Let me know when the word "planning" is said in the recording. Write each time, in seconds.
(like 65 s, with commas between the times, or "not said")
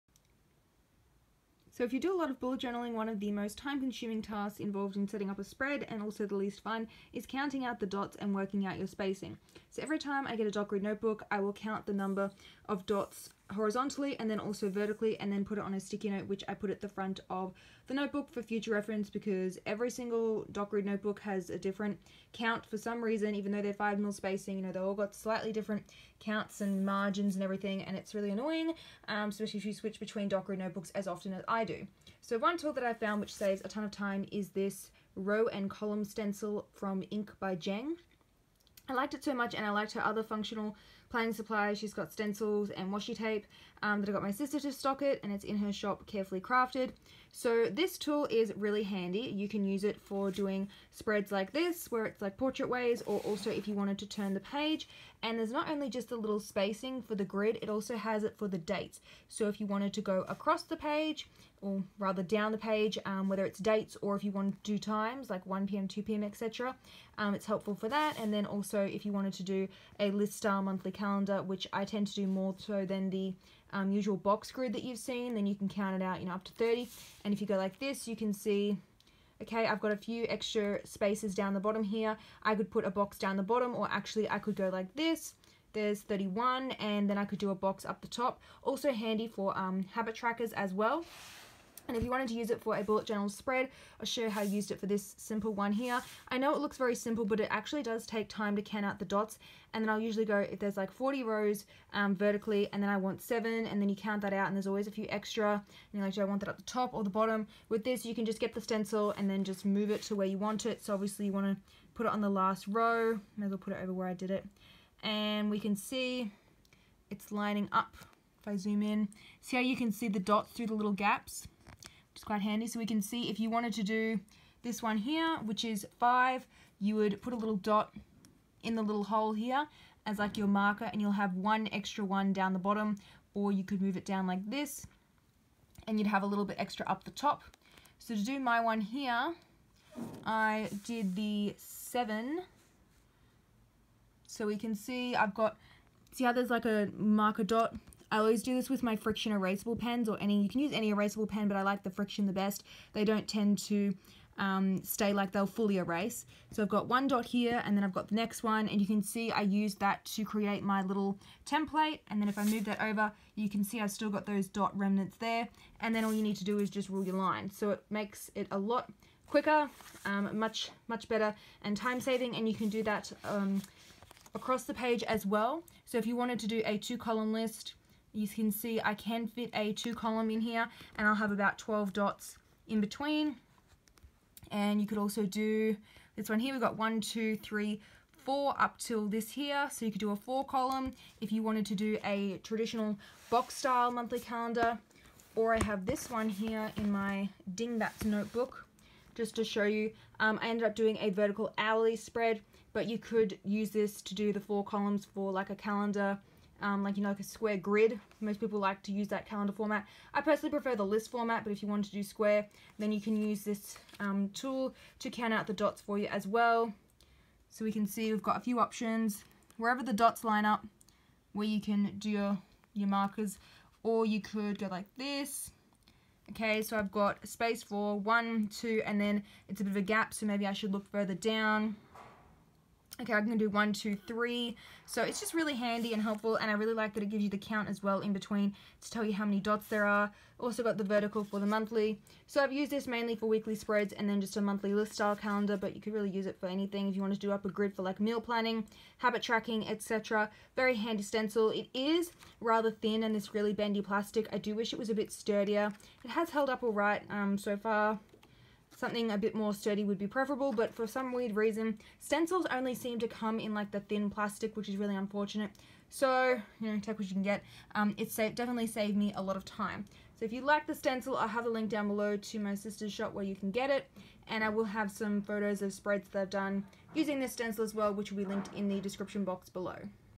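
41 s, 248 s.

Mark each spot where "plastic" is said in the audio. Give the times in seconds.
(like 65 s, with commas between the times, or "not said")
253 s, 264 s.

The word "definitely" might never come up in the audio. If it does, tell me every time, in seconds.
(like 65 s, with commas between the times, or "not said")
268 s.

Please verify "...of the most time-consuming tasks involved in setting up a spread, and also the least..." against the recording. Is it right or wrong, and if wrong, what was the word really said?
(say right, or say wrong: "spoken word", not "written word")
right.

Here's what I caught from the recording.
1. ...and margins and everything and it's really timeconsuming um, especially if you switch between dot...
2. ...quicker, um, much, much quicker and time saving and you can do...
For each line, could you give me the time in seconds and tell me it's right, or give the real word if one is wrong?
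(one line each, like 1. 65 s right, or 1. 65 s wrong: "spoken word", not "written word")
1. 26 s wrong: "annoying", not "timeconsuming"
2. 169 s wrong: "better", not "quicker".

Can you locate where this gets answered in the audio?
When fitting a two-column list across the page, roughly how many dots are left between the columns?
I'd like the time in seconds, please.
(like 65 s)
181 s.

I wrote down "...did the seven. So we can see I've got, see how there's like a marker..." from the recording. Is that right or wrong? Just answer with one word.
right.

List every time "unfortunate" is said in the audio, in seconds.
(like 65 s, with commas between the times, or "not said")
264 s.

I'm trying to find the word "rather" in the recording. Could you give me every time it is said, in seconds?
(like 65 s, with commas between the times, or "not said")
61 s, 252 s.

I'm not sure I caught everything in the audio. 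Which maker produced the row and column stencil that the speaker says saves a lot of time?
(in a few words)
Ink by Jeng.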